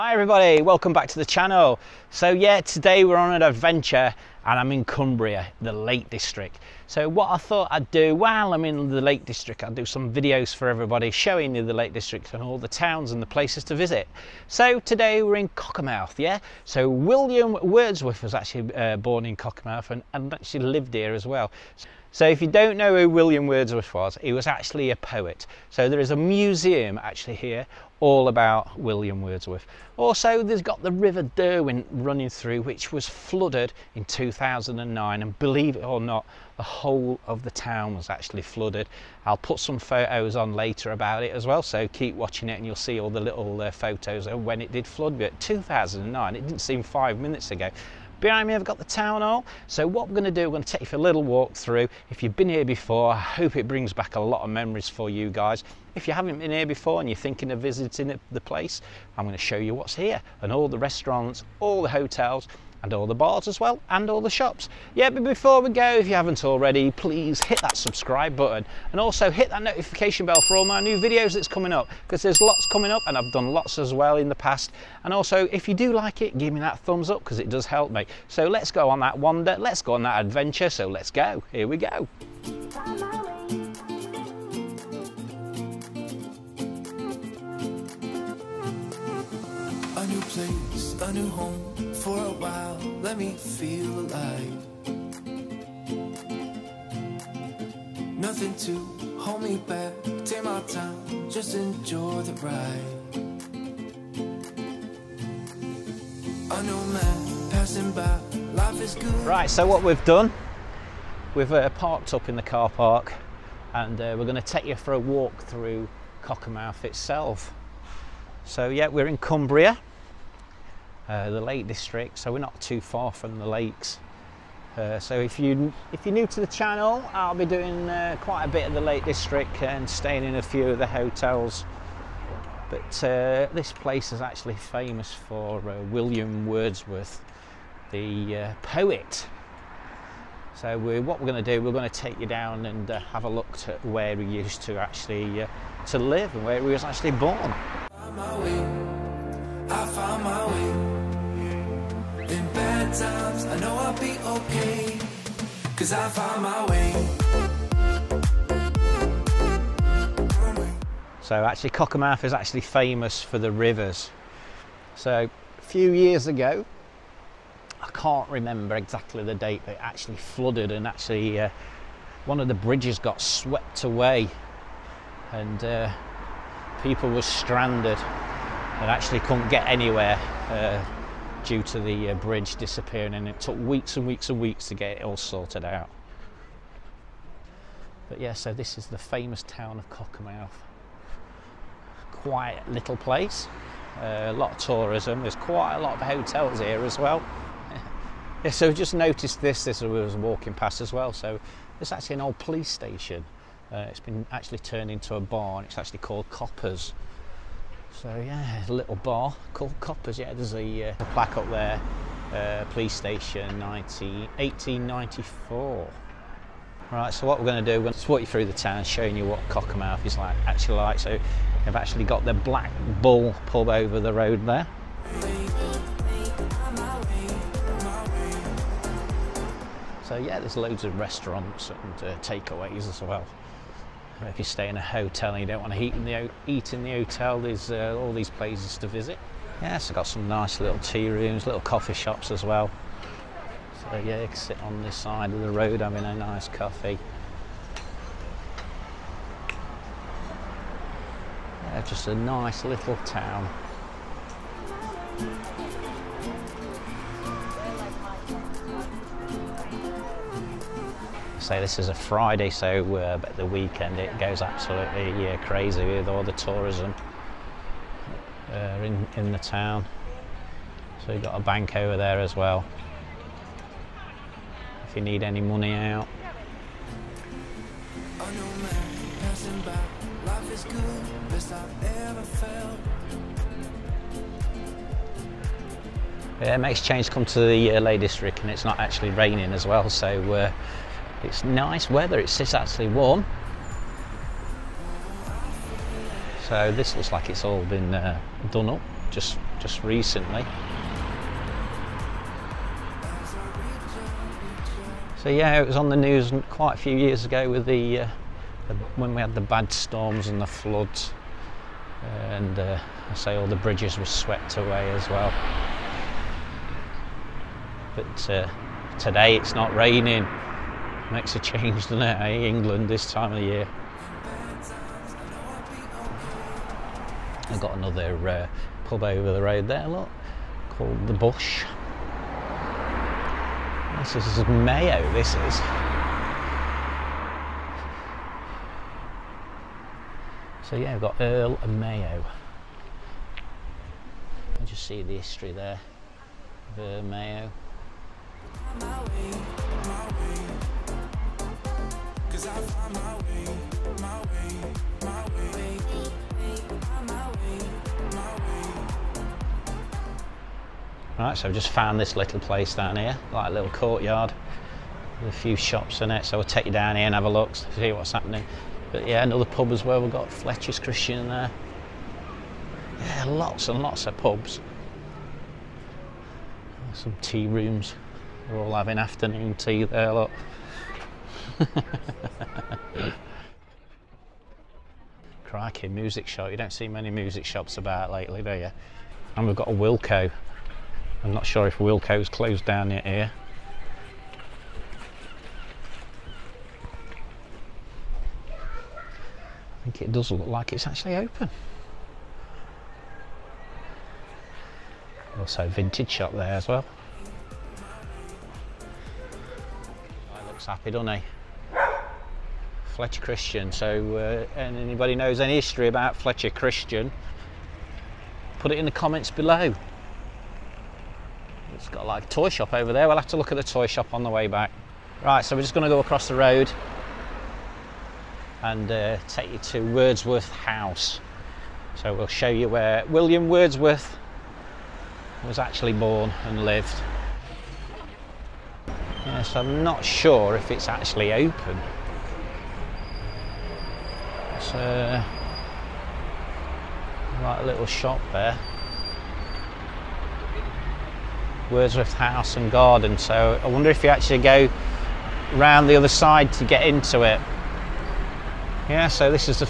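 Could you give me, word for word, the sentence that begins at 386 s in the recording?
You don't see many music shops about lately, do you?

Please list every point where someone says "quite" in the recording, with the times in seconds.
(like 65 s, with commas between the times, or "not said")
128 s, 195 s, 306 s.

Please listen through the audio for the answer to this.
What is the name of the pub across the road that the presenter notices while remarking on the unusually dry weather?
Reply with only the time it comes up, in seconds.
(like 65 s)
331 s.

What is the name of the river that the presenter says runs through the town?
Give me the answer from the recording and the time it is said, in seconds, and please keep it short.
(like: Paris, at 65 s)
River Derwent, at 30 s.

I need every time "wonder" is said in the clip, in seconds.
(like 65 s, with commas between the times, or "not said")
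79 s, 453 s.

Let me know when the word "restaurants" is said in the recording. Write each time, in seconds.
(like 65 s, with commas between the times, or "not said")
60 s, 230 s.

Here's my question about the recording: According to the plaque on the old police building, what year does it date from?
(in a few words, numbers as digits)
1894.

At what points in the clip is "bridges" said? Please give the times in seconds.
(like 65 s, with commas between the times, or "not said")
172 s, 182 s, 313 s.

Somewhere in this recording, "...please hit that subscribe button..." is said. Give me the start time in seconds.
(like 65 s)
66 s.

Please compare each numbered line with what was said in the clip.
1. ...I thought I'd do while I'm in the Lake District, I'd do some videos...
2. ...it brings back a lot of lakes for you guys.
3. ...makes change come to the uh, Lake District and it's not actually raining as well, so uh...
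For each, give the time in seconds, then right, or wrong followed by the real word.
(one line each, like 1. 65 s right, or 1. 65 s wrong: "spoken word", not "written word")
1. 7 s right
2. 53 s wrong: "memories", not "lakes"
3. 286 s right.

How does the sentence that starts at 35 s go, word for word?
And believe it or not, the whole of the town was actually flooded.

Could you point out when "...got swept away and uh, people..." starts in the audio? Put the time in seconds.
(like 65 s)
172 s.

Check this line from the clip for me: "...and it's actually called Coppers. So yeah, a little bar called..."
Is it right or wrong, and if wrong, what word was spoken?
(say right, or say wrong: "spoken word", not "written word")
right.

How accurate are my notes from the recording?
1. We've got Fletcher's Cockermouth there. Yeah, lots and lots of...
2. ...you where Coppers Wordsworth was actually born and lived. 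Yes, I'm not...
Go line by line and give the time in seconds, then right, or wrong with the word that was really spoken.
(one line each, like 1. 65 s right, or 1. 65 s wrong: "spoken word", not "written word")
1. 369 s wrong: "Christian", not "Cockermouth"
2. 432 s wrong: "William", not "Coppers".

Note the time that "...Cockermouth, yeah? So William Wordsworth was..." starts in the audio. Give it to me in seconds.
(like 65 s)
15 s.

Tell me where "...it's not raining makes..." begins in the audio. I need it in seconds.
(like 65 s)
319 s.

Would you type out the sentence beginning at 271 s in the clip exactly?
So we've got a bank over there as well.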